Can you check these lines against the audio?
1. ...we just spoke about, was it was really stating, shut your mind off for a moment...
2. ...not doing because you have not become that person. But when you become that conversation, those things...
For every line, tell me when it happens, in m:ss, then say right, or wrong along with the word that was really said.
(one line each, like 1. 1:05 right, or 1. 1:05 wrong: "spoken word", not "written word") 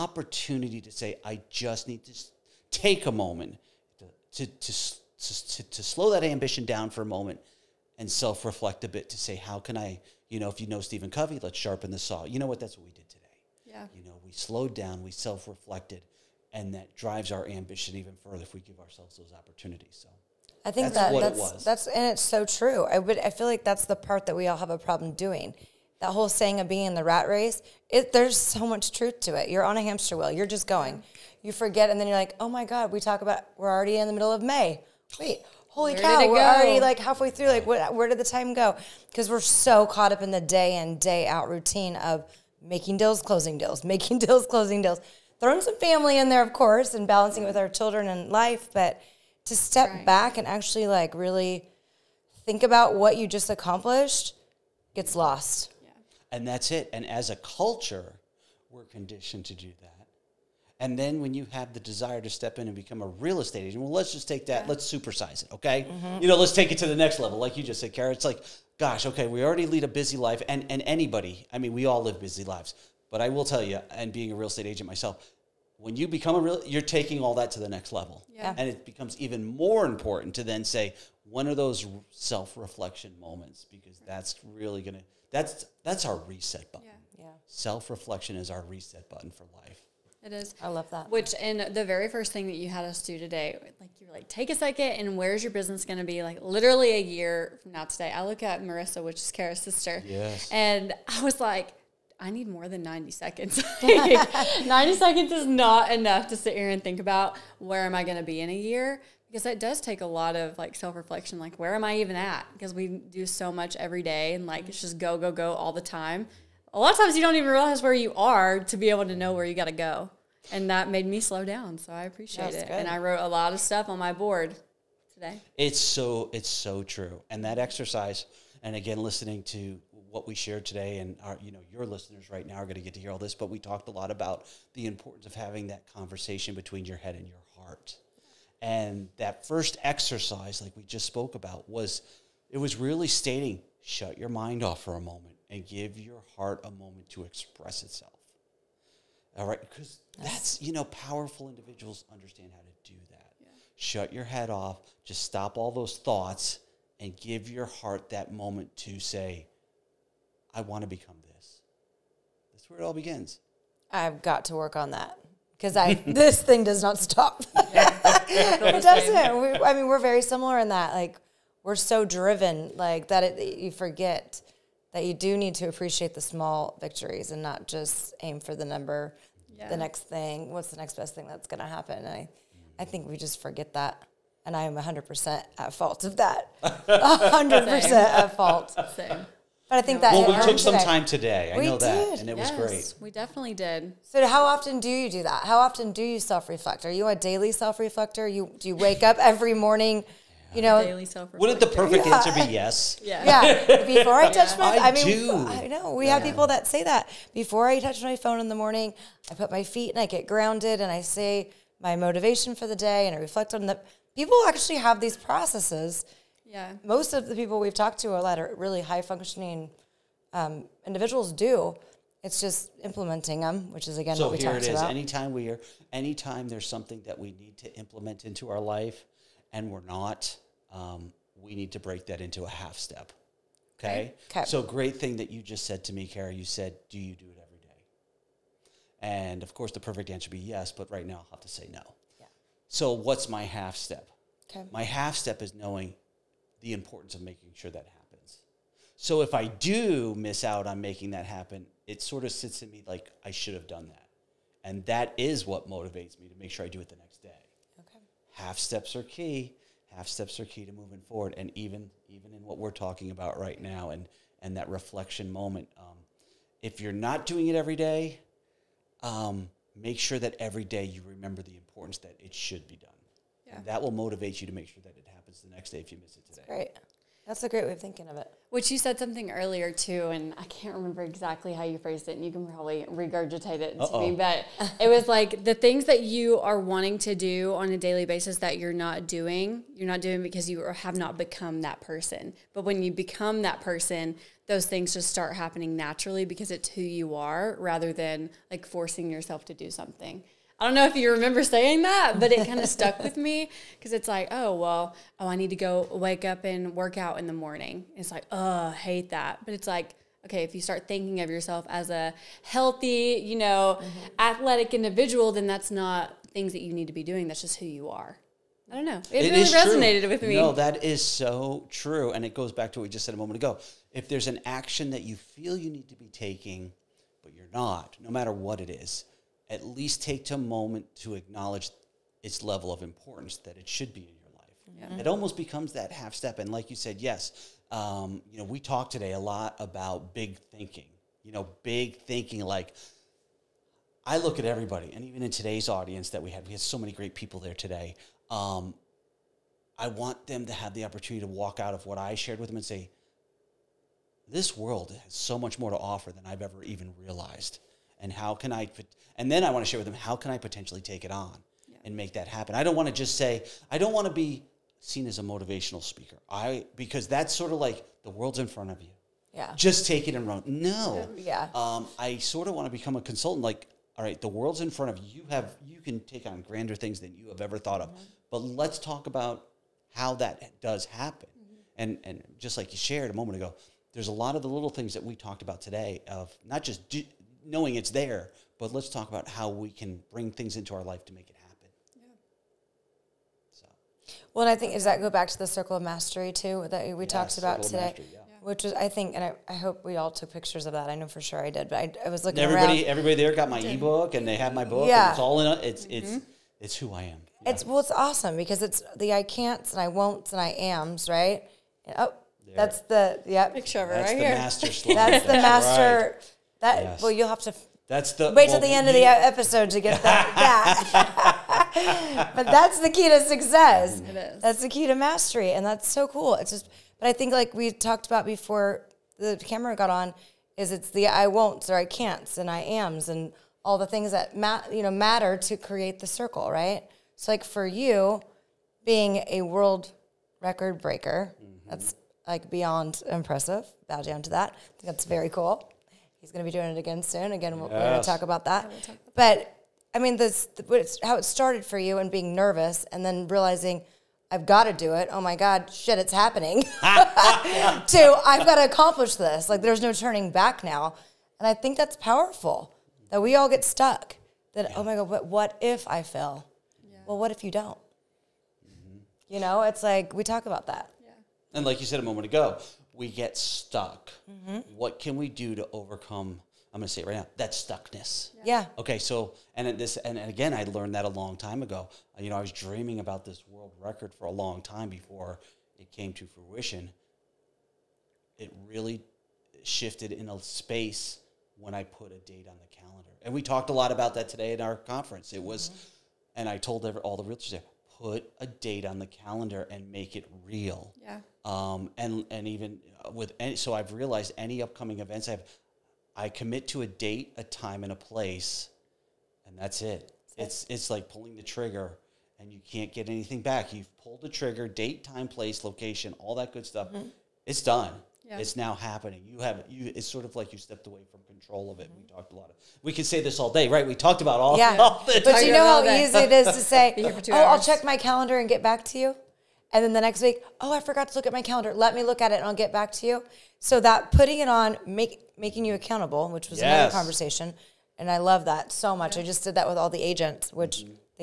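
1. 2:20 right
2. 4:49 wrong: "person", not "conversation".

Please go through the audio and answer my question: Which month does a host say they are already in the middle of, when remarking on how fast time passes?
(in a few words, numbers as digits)
May.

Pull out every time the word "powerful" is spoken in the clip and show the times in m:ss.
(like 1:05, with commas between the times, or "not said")
2:30, 7:41.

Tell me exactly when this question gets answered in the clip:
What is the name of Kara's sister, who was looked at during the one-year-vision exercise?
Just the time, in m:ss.
1:38.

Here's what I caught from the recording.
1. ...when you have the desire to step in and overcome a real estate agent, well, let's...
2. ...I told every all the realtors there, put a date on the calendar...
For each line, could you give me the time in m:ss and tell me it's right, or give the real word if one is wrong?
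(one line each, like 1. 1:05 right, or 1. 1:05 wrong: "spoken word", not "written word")
1. 1:01 wrong: "become", not "overcome"
2. 8:16 right.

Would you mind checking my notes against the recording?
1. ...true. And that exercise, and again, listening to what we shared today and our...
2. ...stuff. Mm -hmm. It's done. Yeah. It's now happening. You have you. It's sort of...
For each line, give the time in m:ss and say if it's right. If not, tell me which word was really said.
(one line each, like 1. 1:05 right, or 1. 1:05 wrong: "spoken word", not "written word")
1. 2:06 right
2. 8:36 right.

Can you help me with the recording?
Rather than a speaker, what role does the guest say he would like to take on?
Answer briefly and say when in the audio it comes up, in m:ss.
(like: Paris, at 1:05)
Consultant, at 6:12.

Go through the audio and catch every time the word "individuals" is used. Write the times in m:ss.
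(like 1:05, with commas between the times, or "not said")
2:31, 3:40, 5:14.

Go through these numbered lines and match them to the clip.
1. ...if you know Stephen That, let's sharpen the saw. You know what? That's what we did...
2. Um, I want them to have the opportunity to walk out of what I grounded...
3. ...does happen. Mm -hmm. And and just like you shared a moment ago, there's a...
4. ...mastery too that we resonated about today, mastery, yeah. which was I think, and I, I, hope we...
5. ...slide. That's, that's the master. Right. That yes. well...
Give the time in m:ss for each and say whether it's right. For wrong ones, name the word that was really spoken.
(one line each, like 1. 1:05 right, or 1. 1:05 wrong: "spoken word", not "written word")
1. 0:10 wrong: "Covey", not "That"
2. 5:48 wrong: "shared", not "grounded"
3. 6:20 right
4. 6:35 wrong: "talked", not "resonated"
5. 6:54 right.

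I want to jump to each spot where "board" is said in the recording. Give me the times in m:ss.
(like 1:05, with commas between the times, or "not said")
2:04.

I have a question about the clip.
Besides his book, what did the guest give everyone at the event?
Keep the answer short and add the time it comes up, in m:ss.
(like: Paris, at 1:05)
Ebook, at 6:43.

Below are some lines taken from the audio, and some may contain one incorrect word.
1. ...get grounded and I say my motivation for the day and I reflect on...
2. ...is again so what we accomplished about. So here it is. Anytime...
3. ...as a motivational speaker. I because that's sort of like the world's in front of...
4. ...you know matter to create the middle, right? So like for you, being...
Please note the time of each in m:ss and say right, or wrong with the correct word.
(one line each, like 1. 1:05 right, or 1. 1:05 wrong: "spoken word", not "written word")
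1. 3:30 right
2. 3:43 wrong: "talked", not "accomplished"
3. 6:05 right
4. 7:14 wrong: "circle", not "middle".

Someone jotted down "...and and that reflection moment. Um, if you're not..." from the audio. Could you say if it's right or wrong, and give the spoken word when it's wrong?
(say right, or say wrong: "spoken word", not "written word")
right.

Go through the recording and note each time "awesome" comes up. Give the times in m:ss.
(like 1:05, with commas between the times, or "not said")
6:47.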